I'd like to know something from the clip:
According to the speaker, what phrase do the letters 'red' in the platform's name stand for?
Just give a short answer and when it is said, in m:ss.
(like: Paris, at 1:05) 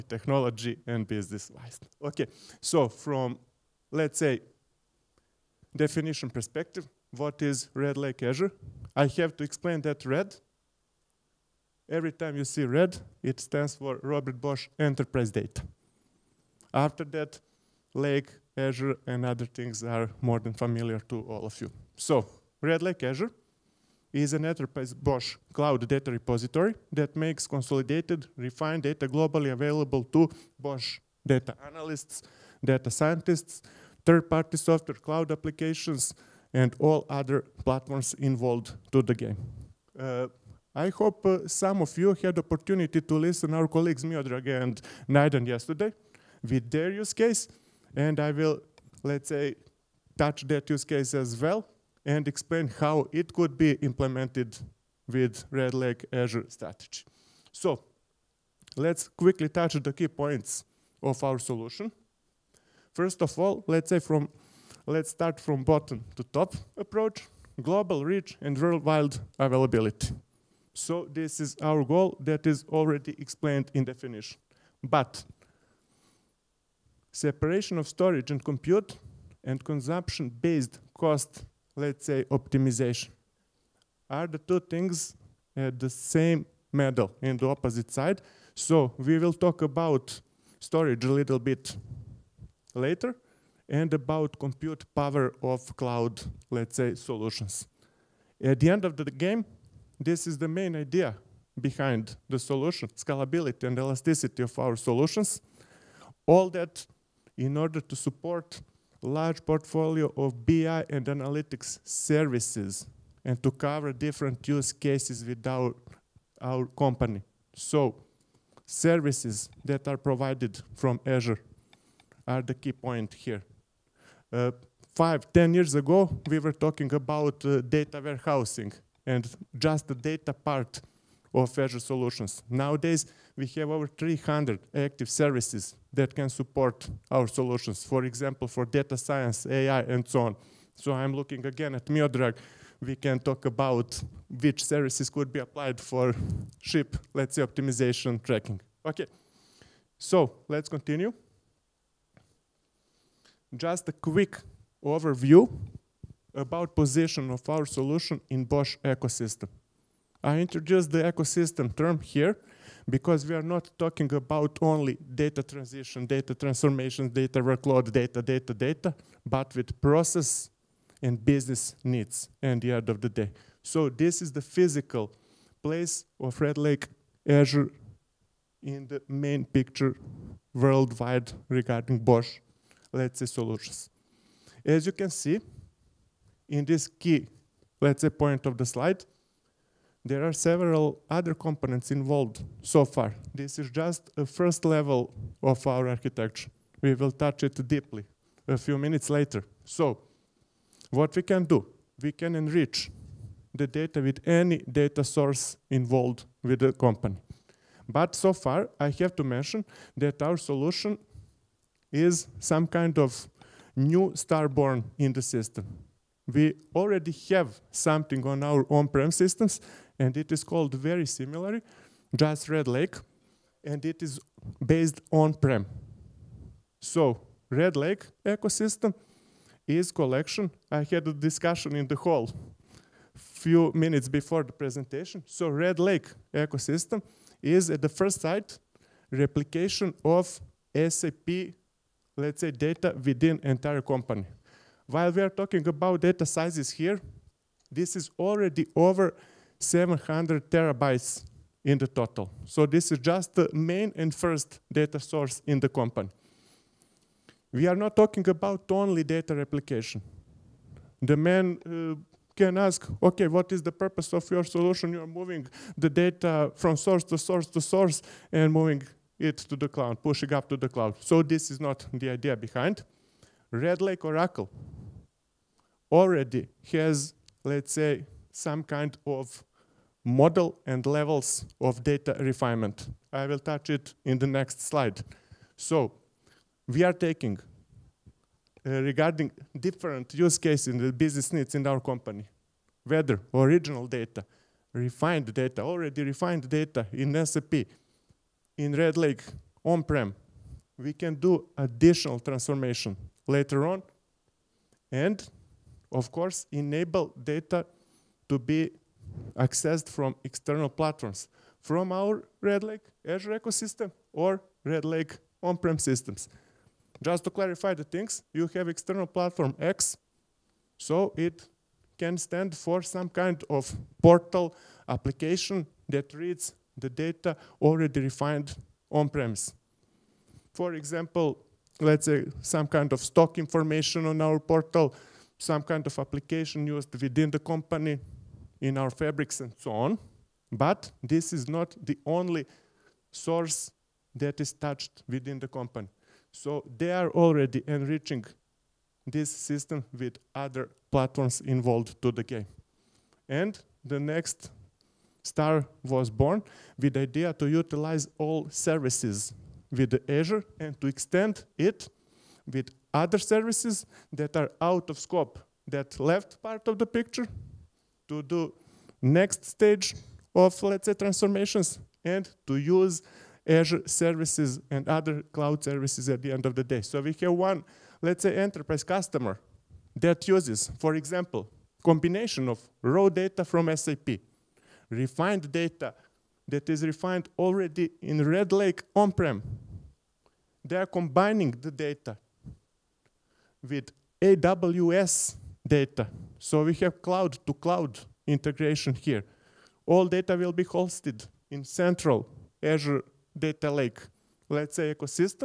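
Robert Bosch Enterprise Data, at 0:14.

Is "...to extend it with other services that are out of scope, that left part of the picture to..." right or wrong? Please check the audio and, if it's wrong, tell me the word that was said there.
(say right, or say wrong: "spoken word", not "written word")
right.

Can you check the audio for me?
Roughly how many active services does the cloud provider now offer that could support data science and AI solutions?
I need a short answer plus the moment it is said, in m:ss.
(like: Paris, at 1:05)
over 300, at 2:13.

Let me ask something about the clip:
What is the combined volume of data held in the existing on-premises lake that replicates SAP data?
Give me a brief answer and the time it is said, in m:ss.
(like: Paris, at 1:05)
over 700 terabytes, at 4:08.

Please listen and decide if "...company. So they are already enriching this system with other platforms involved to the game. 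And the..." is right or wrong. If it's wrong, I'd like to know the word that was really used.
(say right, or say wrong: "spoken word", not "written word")
right.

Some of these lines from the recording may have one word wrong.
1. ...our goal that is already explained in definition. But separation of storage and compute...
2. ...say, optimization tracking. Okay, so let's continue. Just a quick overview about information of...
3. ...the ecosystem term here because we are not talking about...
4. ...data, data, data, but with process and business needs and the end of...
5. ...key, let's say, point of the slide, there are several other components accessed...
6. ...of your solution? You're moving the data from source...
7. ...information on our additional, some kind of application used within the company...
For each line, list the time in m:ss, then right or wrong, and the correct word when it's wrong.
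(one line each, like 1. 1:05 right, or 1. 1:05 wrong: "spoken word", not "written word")
1. 1:11 right
2. 2:27 wrong: "position", not "information"
3. 2:40 right
4. 2:47 right
5. 3:06 wrong: "involved", not "accessed"
6. 4:24 right
7. 5:33 wrong: "portal", not "additional".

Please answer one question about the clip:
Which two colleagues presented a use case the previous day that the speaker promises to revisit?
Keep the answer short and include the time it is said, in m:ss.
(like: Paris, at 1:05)
Miodrag and Naiden, at 0:44.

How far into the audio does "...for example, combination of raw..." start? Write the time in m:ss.
6:20.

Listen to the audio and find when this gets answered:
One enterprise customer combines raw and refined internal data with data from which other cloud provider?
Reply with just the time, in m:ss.
6:34.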